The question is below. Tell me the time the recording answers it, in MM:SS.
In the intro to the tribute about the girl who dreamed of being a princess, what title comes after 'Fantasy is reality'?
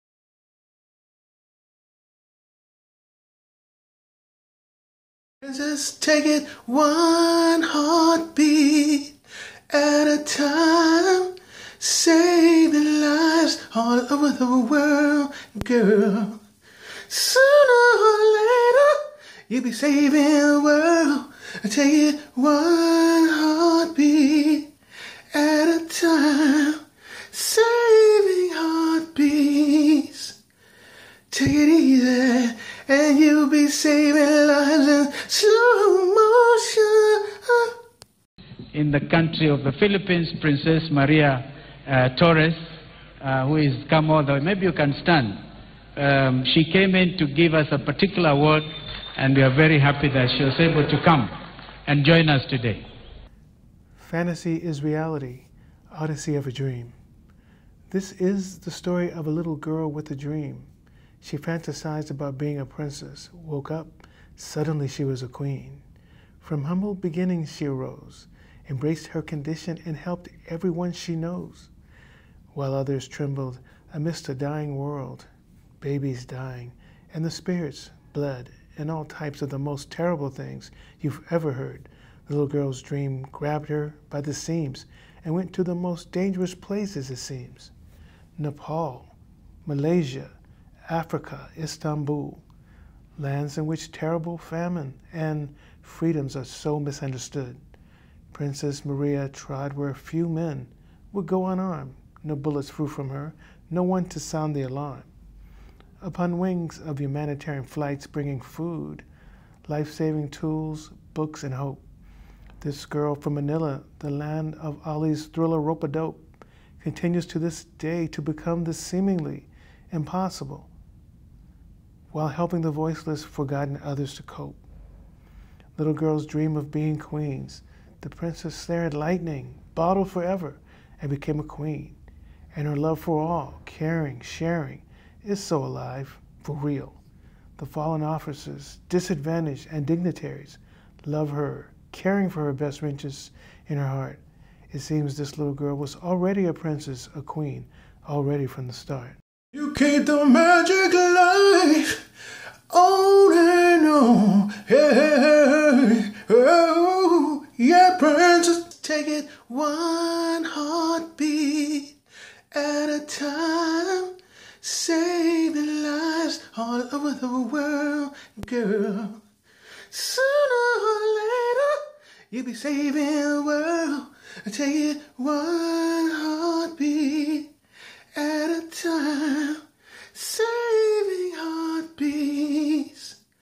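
00:55.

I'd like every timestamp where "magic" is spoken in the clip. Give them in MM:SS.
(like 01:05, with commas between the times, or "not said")
02:30.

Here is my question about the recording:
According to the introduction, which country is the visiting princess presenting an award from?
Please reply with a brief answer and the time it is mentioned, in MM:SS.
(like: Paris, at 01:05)
Philippines, at 00:39.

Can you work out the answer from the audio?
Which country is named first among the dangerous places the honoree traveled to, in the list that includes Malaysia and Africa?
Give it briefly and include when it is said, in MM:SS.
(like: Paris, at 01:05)
Nepal, at 01:28.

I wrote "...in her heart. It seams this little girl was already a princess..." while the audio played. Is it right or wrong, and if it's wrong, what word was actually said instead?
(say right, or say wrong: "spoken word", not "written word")
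wrong: "seems", not "seams".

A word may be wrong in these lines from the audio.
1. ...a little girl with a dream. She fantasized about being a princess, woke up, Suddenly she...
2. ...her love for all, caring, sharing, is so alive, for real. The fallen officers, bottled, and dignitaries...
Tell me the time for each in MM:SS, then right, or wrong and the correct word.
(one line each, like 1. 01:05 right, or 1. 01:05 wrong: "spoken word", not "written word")
1. 00:59 right
2. 02:12 wrong: "disadvantaged", not "bottled".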